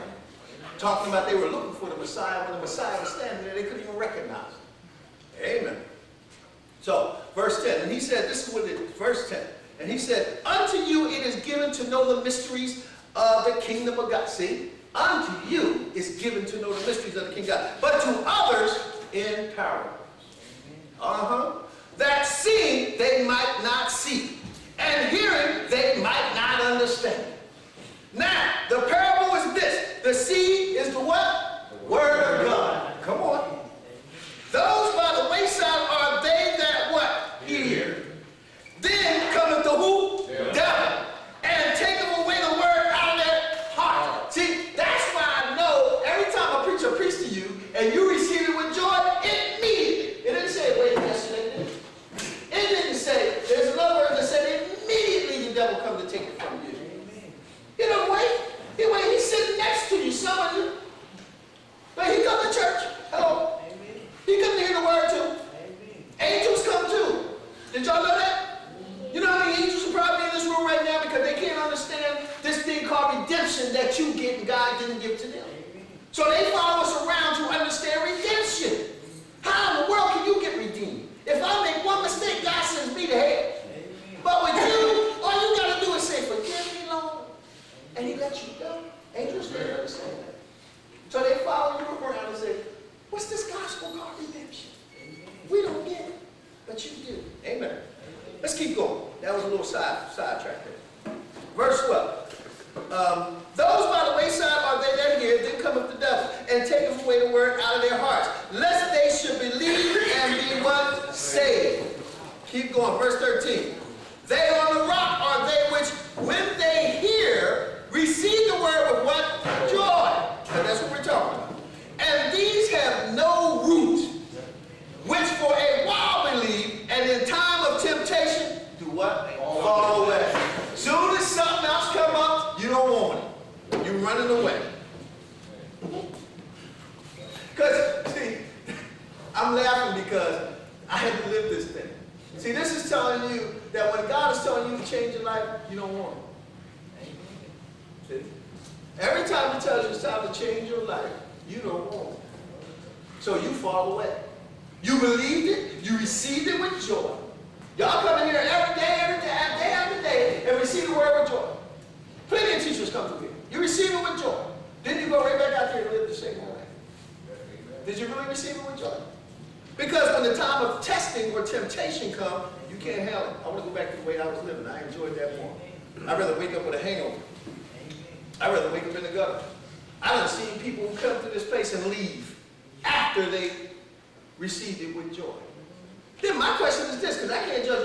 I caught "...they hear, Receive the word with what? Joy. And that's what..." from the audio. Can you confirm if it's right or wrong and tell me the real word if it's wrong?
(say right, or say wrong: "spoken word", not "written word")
right.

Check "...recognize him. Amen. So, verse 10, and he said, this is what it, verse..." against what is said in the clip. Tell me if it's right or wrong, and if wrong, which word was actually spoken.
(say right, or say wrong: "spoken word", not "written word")
right.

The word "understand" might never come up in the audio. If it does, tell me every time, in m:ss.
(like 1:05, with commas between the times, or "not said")
0:26, 1:29.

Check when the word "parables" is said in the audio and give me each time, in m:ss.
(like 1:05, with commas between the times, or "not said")
0:19, 0:28.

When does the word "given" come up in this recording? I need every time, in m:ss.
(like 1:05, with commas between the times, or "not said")
0:11, 0:16.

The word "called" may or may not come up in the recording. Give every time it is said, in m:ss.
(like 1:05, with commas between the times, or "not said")
1:33.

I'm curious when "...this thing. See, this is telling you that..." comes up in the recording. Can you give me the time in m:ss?
2:21.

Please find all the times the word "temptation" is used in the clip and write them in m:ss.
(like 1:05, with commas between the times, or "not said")
2:07, 2:51.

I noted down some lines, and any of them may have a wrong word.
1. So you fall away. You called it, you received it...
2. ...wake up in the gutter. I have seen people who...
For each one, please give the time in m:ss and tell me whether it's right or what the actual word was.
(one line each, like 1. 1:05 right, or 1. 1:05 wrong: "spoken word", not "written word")
1. 2:33 wrong: "believed", not "called"
2. 2:58 right.